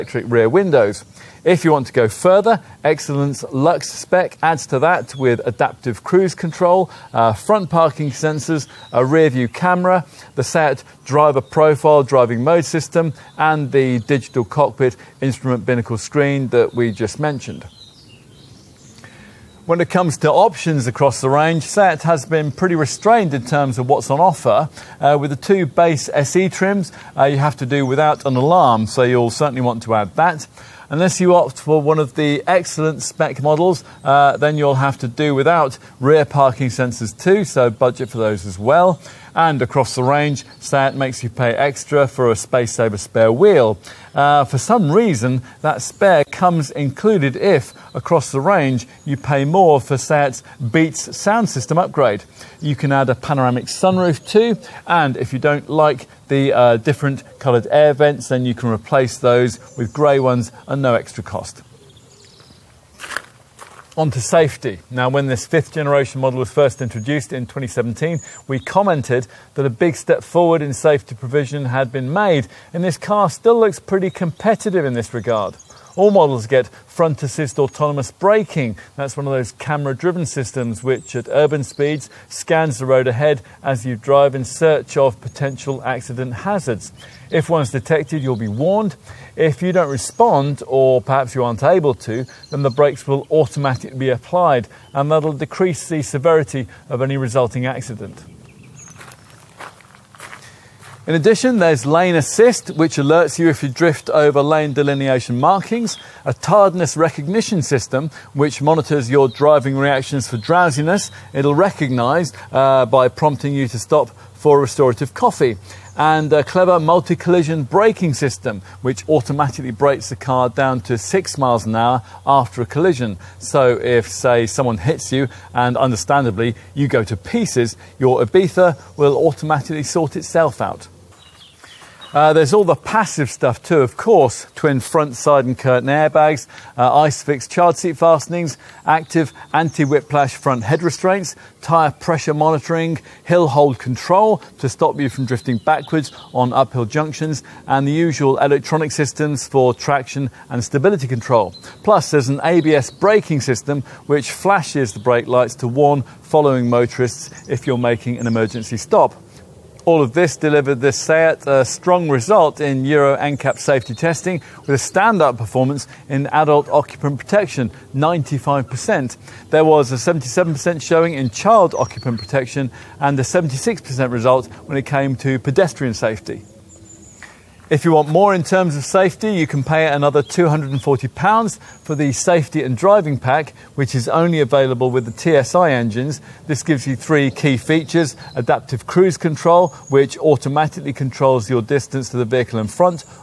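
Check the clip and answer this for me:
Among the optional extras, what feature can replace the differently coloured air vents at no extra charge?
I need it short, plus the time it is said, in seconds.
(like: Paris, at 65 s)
Grey ones, at 59 s.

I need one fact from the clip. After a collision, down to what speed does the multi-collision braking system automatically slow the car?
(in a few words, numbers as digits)
6 miles an hour.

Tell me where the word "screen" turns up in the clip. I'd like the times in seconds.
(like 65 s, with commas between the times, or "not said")
15 s.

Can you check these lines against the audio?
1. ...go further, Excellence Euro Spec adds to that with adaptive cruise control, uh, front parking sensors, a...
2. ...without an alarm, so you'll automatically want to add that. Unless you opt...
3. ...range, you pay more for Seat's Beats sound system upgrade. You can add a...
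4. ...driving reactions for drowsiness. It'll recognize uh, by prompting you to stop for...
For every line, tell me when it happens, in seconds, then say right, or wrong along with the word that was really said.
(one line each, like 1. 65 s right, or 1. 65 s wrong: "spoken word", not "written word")
1. 1 s wrong: "Lux", not "Euro"
2. 27 s wrong: "certainly", not "automatically"
3. 48 s right
4. 109 s right.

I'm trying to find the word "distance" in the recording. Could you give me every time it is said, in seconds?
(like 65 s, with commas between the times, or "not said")
191 s.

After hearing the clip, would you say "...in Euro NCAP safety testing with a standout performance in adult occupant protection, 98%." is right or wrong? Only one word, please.
wrong.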